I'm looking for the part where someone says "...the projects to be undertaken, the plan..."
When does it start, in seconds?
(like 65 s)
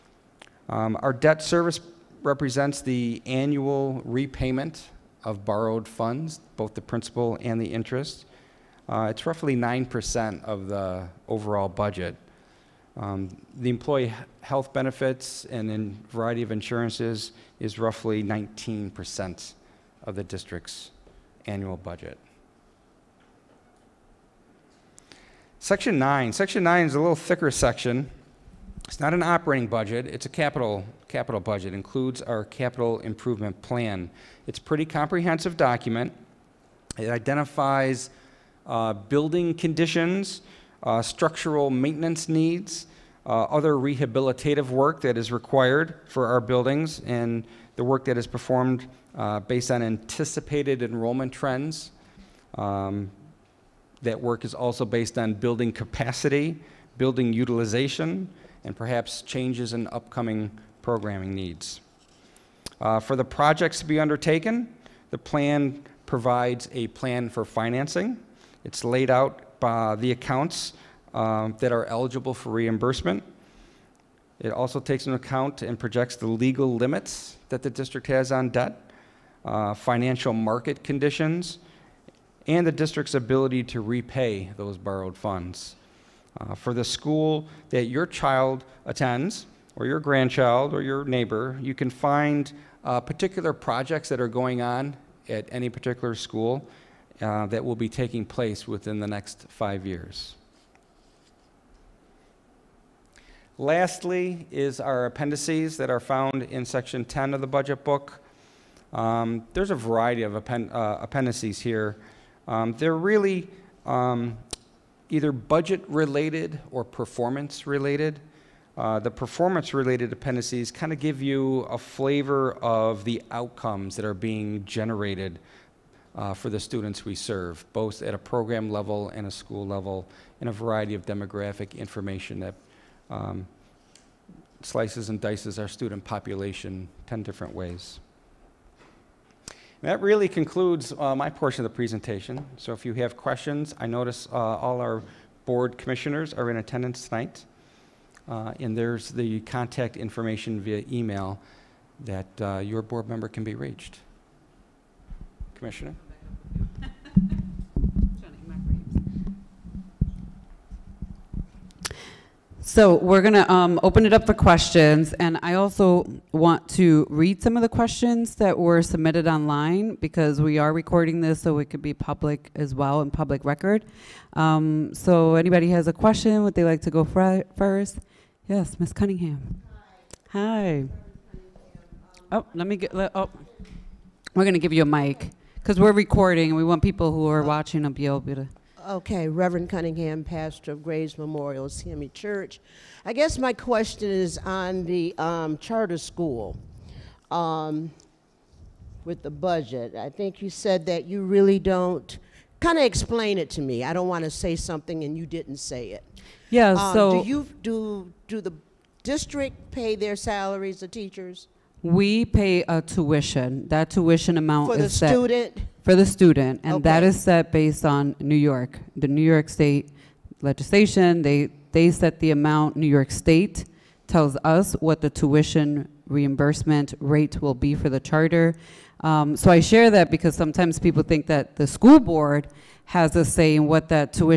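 63 s.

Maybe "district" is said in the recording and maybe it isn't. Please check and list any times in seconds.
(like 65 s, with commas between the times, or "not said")
20 s, 77 s, 82 s, 209 s.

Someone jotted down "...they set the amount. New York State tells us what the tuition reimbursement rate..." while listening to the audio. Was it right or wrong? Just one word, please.
right.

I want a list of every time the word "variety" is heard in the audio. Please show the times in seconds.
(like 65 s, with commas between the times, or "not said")
16 s, 109 s, 130 s.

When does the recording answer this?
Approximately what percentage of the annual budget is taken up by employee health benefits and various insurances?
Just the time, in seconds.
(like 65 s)
18 s.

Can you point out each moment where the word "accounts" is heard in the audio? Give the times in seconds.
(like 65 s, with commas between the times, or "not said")
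70 s, 75 s.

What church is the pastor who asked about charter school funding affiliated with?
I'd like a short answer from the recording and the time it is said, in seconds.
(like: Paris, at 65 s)
Graves Memorial CME Church, at 190 s.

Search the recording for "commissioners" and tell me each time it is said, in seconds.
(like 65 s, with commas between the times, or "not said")
145 s, 155 s.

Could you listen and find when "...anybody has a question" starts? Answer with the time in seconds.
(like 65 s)
175 s.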